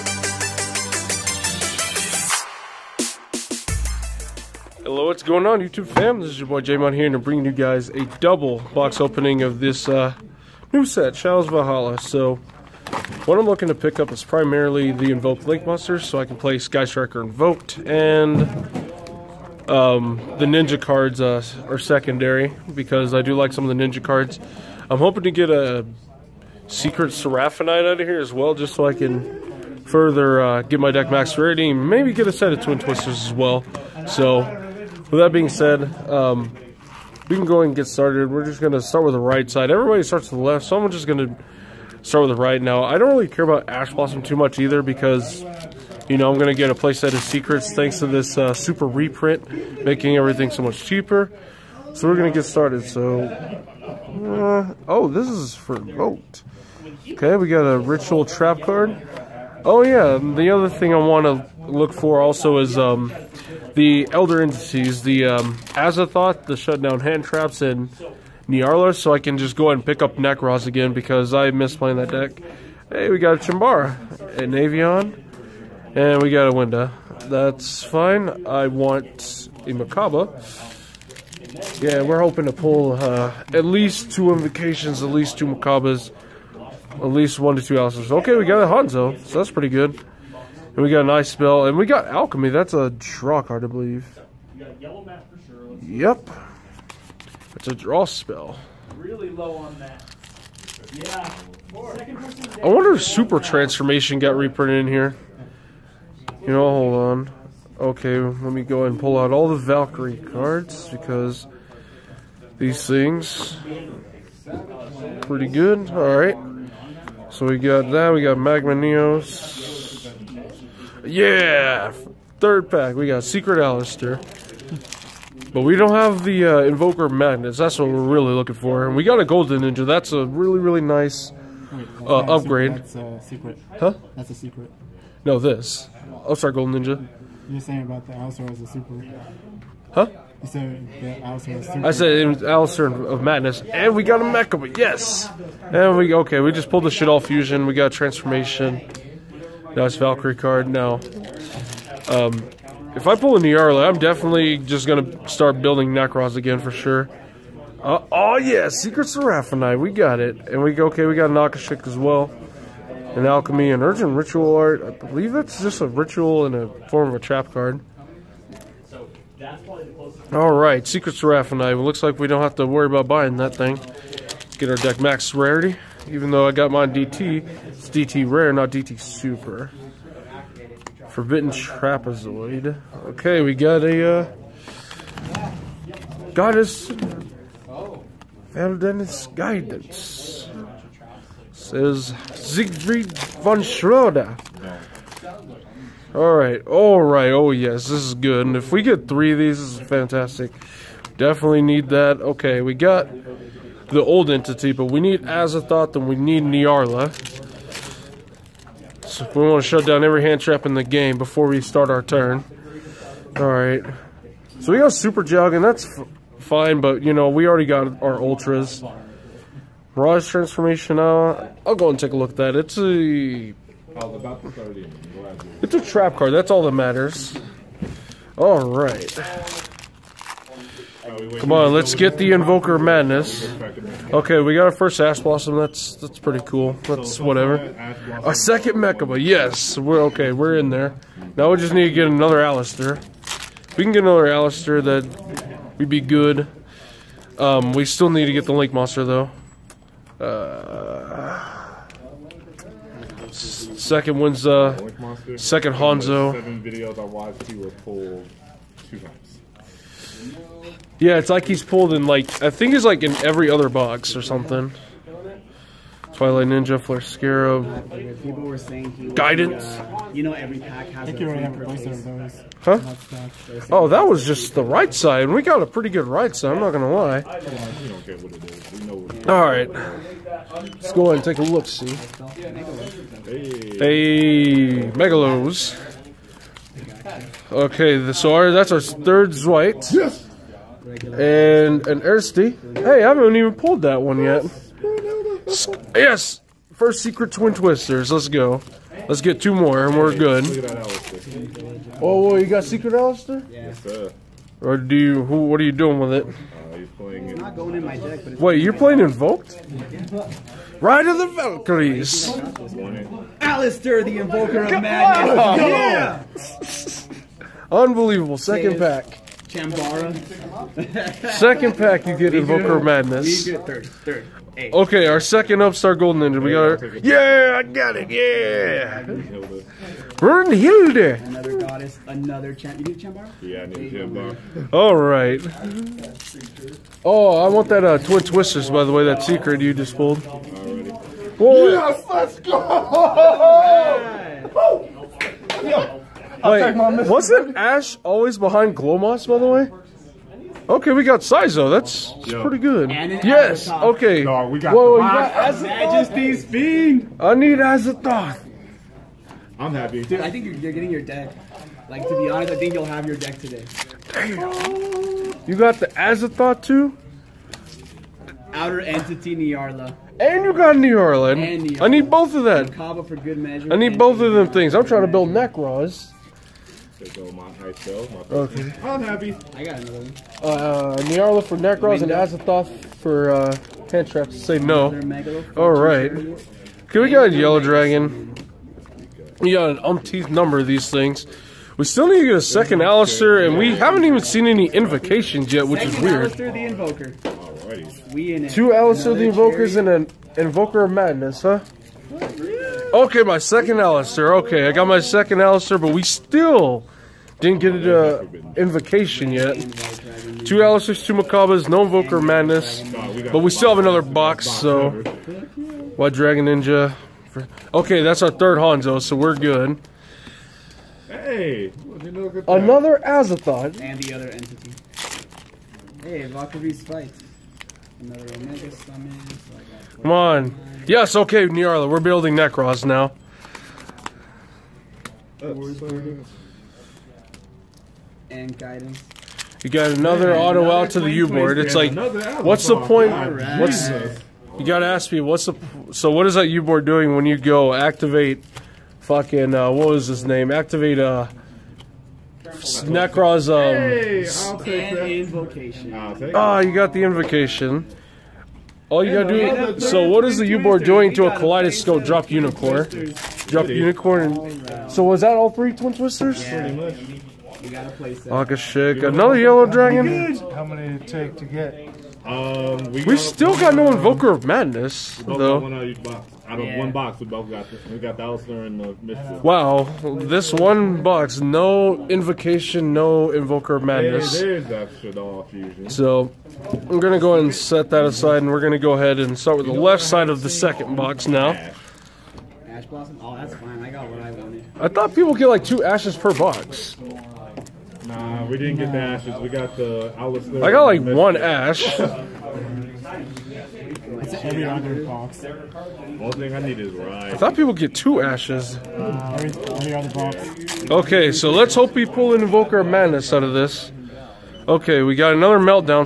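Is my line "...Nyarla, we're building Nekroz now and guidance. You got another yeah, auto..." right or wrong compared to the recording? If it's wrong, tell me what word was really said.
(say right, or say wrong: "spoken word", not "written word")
right.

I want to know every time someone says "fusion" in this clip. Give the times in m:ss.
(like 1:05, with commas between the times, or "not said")
2:27, 8:04.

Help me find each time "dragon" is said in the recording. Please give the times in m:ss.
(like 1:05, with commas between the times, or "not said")
6:27, 6:56, 7:49.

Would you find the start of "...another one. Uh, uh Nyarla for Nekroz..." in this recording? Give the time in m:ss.
6:19.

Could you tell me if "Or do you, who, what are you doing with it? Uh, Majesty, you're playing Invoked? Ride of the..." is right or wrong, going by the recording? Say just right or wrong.
wrong.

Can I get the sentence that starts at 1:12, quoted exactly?
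Hey, we got a Chimbara, an Avion, and we got a Winda.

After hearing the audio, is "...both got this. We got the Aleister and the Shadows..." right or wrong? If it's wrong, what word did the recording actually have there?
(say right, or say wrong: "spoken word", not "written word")
wrong: "Wow", not "Shadows".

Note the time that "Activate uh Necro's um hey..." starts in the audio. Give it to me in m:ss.
7:30.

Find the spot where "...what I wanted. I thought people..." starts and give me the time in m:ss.
8:14.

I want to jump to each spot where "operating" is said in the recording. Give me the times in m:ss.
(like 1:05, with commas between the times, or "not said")
not said.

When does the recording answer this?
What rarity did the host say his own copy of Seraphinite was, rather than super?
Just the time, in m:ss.
2:57.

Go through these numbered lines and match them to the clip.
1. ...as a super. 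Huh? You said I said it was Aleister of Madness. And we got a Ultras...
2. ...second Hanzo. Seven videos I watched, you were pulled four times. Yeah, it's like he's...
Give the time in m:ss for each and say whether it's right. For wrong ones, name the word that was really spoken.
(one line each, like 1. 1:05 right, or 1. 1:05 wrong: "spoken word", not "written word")
1. 2:18 wrong: "Mecha", not "Ultras"
2. 4:15 wrong: "two", not "four".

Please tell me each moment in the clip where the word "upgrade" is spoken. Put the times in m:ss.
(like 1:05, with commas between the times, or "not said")
2:12.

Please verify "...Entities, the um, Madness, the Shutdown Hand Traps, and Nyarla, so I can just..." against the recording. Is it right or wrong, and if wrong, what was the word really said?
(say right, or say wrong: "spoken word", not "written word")
wrong: "Azathoth", not "Madness".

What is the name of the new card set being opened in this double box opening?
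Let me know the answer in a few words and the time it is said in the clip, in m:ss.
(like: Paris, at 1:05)
Shadows Valhalla, at 0:11.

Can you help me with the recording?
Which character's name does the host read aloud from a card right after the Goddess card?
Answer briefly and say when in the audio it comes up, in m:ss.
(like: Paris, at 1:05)
Siegfried von Schroeder, at 3:12.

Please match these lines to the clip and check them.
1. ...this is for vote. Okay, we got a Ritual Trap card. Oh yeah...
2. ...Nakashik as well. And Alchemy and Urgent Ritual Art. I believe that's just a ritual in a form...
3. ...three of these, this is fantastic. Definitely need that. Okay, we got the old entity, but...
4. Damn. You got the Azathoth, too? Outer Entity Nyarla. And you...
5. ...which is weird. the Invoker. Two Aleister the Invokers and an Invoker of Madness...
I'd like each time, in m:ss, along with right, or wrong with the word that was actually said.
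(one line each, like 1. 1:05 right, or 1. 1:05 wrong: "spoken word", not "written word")
1. 0:55 right
2. 2:41 right
3. 3:19 right
4. 6:04 right
5. 6:35 right.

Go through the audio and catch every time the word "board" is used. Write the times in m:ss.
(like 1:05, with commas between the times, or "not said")
7:21, 7:26, 7:40.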